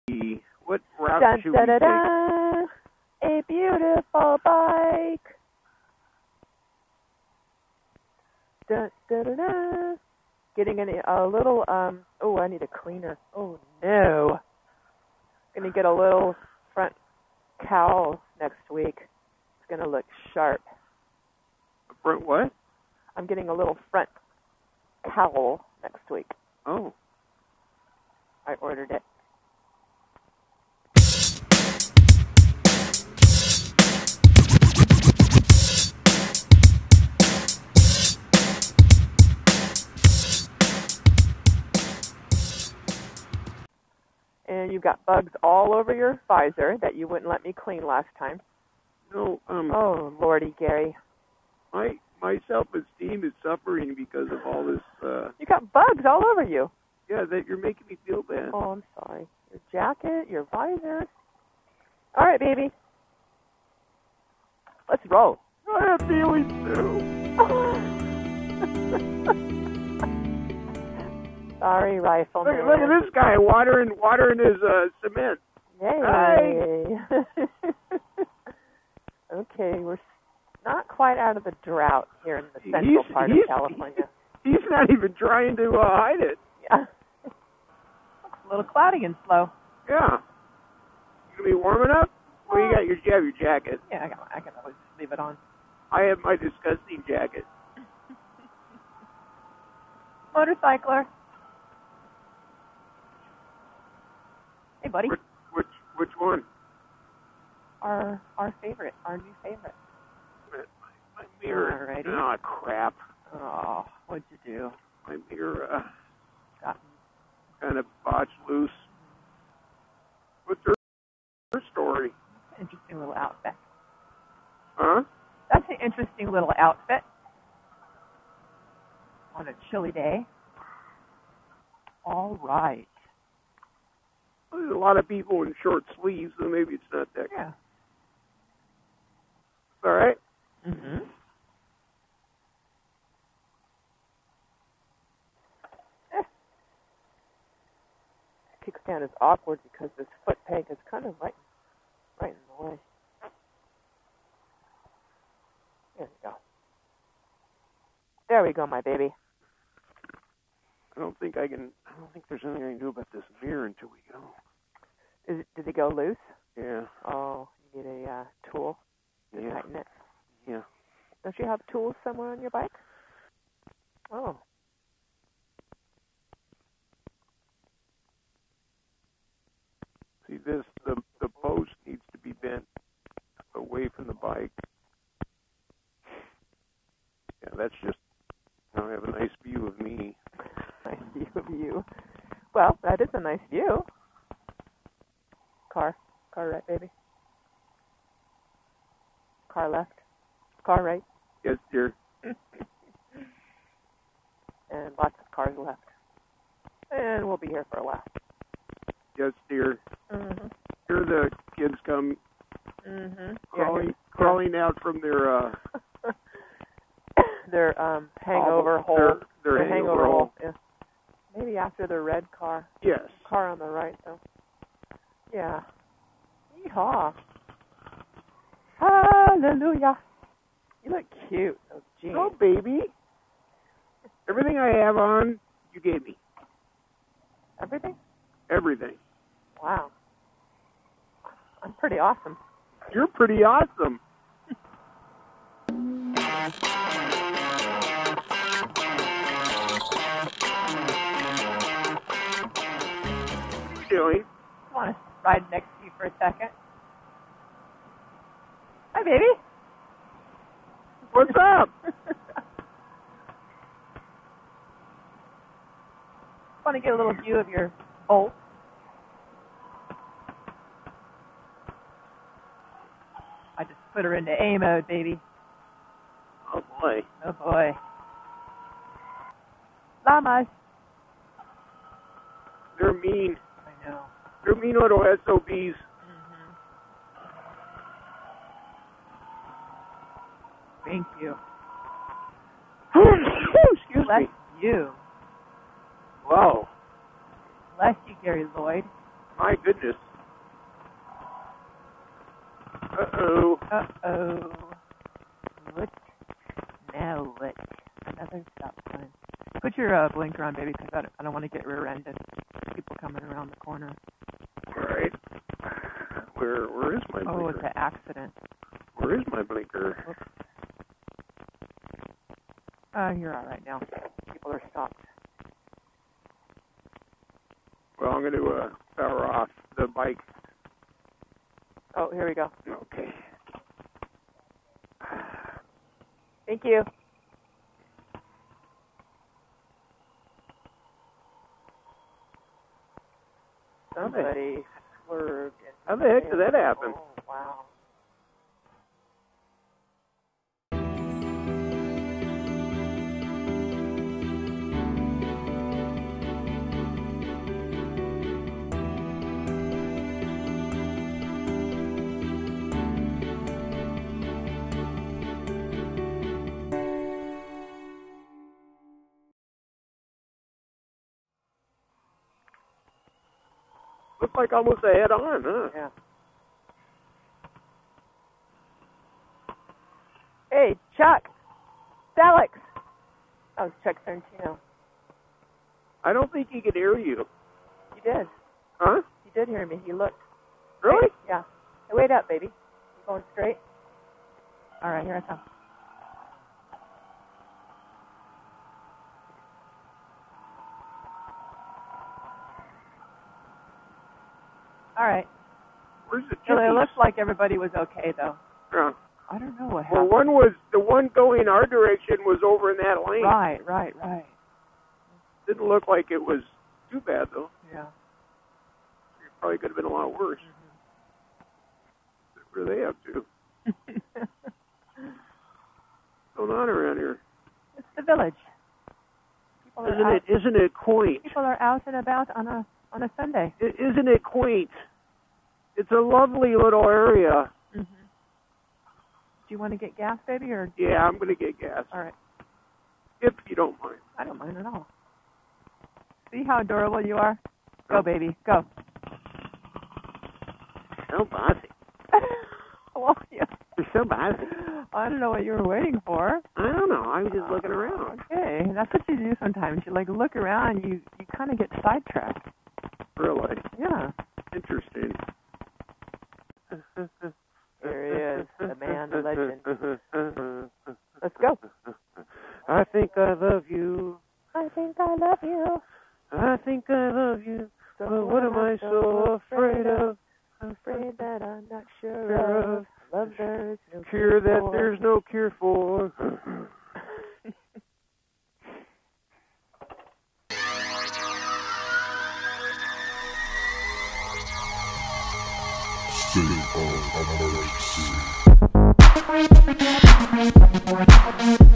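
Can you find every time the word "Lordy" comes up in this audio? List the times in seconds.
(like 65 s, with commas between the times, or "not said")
50 s.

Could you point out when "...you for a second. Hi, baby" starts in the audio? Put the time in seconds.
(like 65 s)
255 s.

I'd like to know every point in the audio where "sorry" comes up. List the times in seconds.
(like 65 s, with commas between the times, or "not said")
58 s, 71 s.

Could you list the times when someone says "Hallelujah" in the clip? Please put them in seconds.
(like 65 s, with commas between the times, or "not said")
228 s.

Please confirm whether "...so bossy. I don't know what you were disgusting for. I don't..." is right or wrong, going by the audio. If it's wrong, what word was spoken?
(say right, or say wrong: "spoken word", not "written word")
wrong: "waiting", not "disgusting".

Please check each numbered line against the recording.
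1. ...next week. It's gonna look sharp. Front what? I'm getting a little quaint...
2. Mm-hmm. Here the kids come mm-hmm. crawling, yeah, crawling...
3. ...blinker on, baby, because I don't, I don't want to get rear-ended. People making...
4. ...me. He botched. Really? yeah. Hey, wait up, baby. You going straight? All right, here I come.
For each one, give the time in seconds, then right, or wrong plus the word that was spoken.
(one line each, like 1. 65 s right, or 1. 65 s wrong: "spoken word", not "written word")
1. 18 s wrong: "front", not "quaint"
2. 210 s right
3. 310 s wrong: "coming", not "making"
4. 389 s wrong: "looked", not "botched".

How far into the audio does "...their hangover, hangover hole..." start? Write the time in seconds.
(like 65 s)
219 s.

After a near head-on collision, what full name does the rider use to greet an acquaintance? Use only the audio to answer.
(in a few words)
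Chuck Santino.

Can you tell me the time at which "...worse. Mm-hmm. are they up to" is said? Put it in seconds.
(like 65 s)
420 s.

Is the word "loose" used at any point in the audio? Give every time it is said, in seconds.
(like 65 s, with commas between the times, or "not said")
118 s, 165 s.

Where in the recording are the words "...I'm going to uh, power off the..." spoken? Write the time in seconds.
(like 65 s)
328 s.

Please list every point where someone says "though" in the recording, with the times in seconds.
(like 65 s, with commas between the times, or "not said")
224 s, 408 s, 417 s.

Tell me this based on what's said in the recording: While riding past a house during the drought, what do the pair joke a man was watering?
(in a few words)
cement.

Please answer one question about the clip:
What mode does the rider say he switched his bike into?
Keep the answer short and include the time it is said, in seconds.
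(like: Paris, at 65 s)
A mode, at 274 s.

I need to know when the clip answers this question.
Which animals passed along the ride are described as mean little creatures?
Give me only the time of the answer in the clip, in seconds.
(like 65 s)
280 s.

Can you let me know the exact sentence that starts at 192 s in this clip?
Well, that is a nice view.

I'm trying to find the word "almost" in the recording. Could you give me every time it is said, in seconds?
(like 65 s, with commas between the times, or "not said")
374 s.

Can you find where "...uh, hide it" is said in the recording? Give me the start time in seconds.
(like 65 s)
85 s.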